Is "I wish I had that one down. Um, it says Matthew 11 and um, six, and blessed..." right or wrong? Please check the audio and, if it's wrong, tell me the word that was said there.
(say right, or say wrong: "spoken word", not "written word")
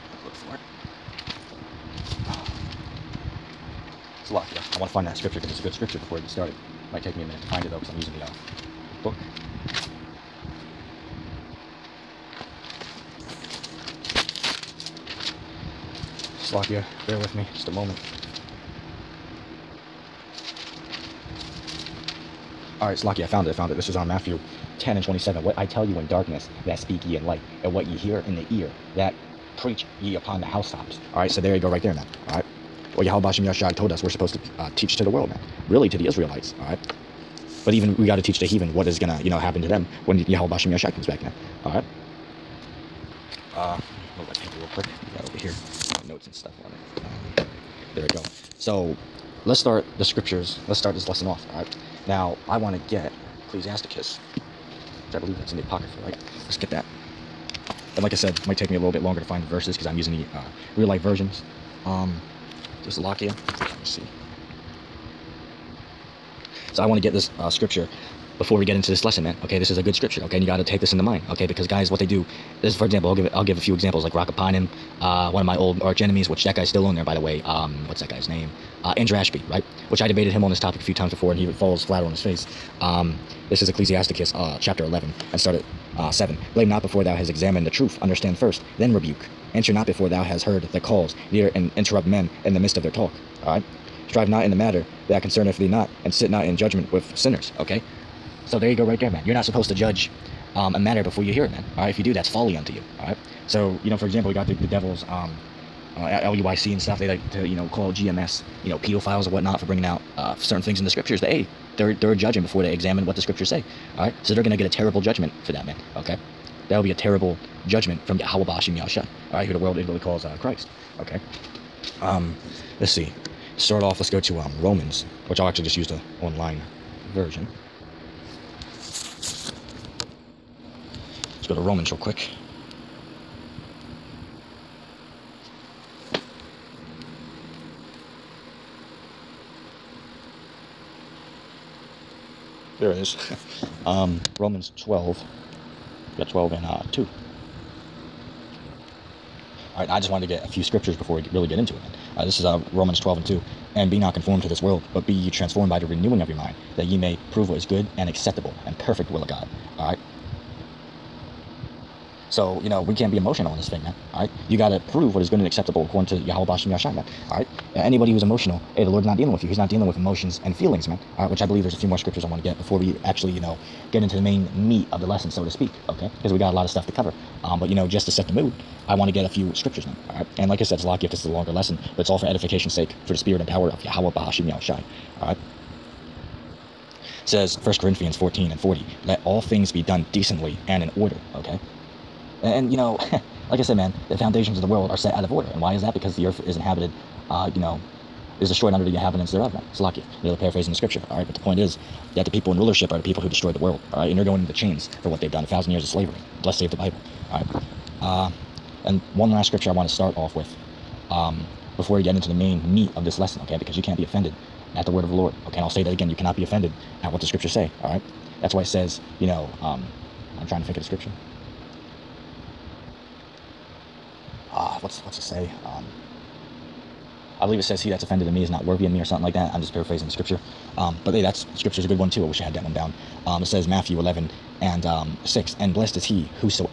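right.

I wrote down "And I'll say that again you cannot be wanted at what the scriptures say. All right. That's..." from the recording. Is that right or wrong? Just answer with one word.
wrong.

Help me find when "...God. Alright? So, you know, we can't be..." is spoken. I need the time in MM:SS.
02:39.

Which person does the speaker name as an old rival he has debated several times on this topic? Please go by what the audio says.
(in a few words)
Andrew Ashby.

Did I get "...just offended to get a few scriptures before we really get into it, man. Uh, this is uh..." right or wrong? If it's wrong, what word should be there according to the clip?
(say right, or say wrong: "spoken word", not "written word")
wrong: "wanted", not "offended".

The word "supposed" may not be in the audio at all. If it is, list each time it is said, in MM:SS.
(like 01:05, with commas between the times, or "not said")
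00:34, 01:39.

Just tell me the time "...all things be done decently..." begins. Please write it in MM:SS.
03:09.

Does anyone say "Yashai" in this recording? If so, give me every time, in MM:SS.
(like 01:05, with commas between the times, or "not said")
00:33, 00:40.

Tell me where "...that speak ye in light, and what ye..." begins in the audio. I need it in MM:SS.
00:26.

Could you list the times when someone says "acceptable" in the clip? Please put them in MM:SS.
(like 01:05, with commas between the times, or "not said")
02:38, 02:45.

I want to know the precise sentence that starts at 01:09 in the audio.
Okay, this is a good scripture.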